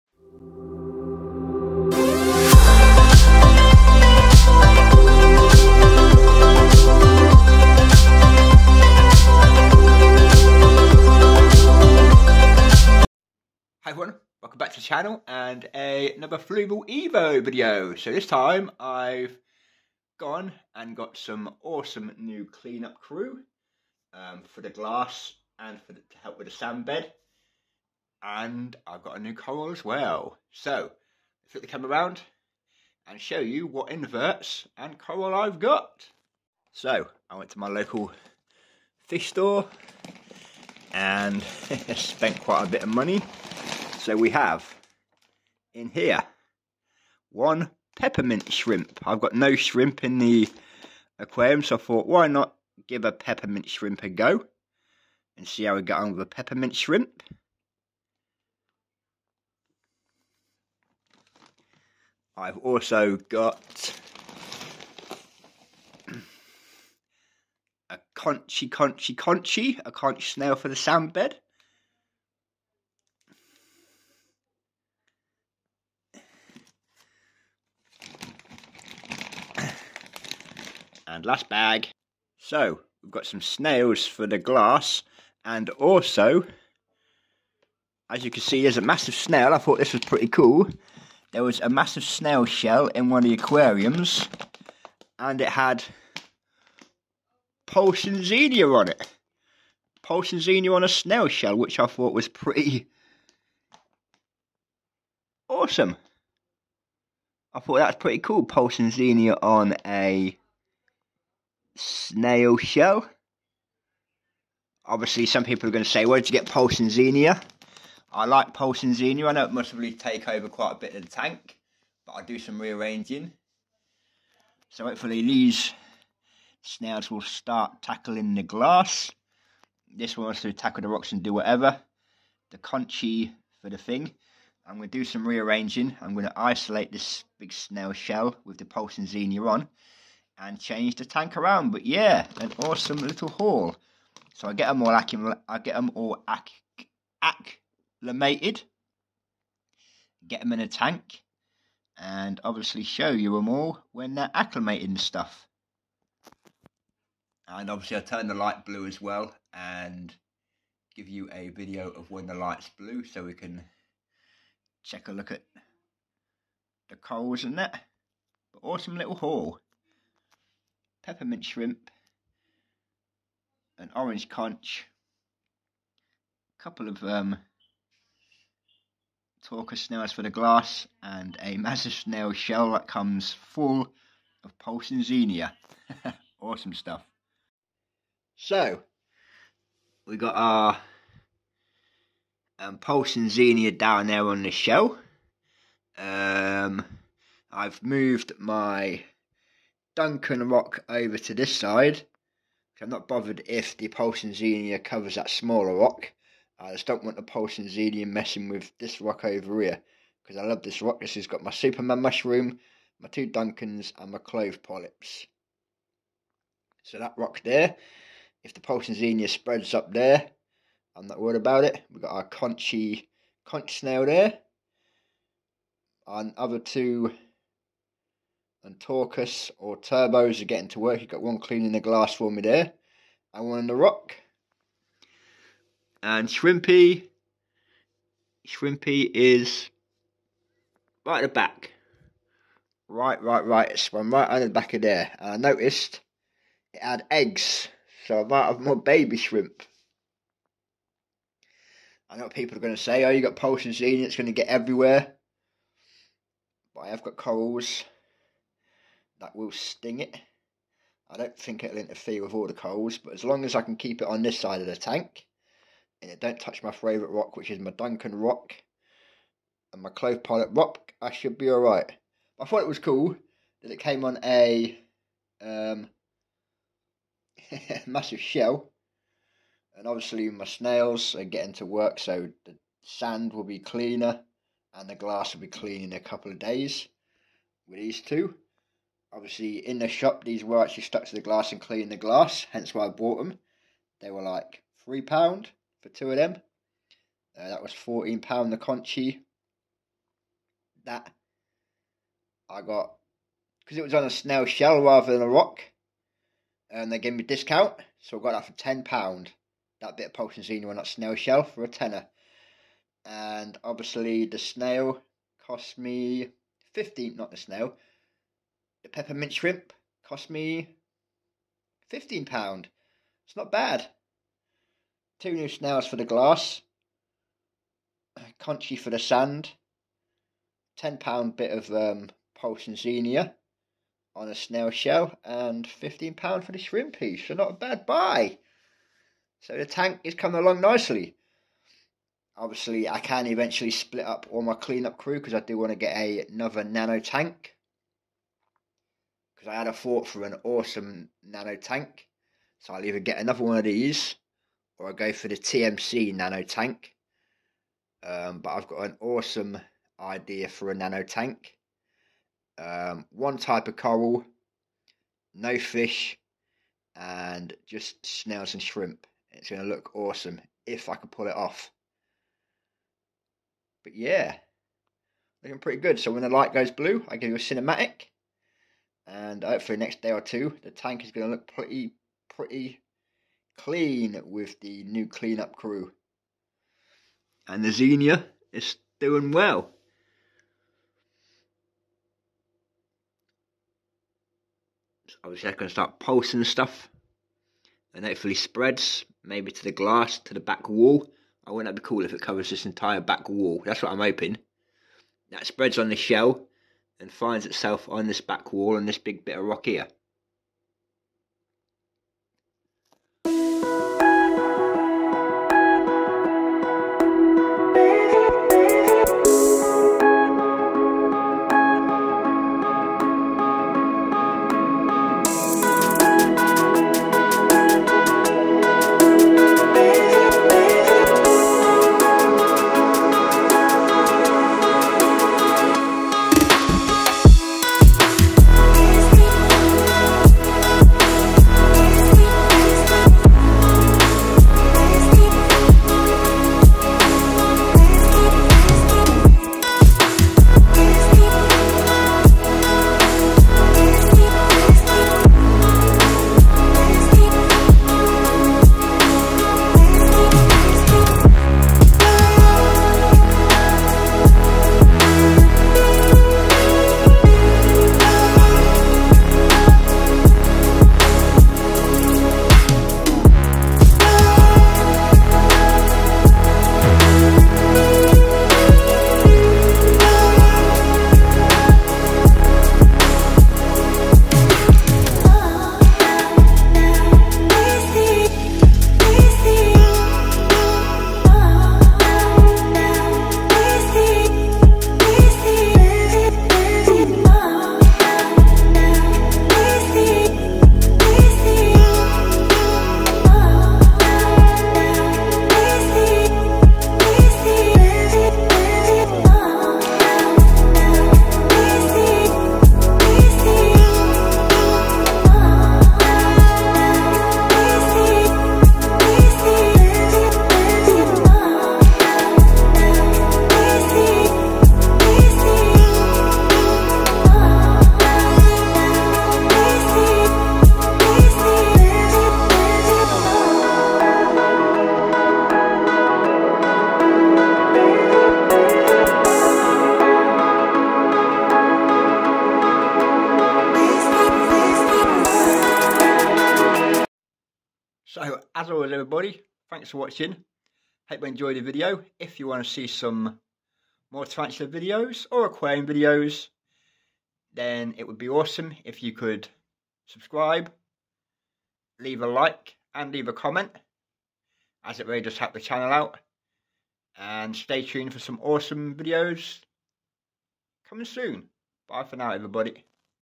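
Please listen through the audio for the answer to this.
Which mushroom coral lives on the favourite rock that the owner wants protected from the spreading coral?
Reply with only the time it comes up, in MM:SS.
03:31.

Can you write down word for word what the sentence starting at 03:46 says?
Our other two and Trochus or Turbos are getting to work.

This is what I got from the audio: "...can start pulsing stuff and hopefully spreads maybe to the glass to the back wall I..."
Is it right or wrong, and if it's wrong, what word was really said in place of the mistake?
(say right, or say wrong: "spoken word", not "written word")
right.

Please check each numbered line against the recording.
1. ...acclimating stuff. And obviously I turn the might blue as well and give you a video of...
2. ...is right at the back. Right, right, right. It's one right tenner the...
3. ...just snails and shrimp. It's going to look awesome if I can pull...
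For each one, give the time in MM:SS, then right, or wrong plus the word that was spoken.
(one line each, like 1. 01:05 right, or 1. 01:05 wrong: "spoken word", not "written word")
1. 02:34 wrong: "light", not "might"
2. 03:59 wrong: "under", not "tenner"
3. 06:07 right.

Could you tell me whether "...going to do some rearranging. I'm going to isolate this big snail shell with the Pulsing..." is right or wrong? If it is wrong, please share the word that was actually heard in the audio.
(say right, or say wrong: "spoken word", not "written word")
right.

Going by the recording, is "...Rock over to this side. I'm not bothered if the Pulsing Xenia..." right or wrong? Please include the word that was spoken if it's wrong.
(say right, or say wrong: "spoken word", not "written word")
right.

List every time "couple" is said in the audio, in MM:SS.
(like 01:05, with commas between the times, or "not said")
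02:56, 04:45.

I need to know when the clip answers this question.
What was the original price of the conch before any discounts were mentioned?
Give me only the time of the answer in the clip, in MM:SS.
04:57.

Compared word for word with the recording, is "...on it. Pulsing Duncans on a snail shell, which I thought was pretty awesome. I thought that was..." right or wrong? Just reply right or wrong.
wrong.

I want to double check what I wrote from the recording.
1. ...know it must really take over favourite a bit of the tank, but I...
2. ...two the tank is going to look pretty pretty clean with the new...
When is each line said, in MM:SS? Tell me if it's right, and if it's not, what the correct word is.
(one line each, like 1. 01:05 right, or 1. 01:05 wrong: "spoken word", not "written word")
1. 01:59 wrong: "quite", not "favourite"
2. 06:20 right.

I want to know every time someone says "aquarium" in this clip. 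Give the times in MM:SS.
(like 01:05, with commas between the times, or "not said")
00:51, 01:33, 09:15.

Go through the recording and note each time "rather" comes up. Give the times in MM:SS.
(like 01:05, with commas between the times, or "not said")
05:04.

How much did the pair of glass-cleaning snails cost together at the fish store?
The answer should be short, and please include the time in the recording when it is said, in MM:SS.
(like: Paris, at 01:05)
£3, at 04:54.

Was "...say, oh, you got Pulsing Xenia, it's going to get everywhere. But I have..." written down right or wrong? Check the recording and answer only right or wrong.
right.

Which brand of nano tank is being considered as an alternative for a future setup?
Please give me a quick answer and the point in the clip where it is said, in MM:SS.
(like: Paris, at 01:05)
TMC, at 05:55.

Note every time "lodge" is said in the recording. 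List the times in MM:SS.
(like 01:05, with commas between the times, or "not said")
not said.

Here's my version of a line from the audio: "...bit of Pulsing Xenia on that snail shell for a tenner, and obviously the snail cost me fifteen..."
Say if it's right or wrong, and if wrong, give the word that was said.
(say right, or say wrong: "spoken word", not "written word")
right.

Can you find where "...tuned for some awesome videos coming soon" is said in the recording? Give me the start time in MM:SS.
09:27.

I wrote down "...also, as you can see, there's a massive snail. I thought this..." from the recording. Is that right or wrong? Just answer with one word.
right.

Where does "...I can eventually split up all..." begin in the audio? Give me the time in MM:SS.
05:42.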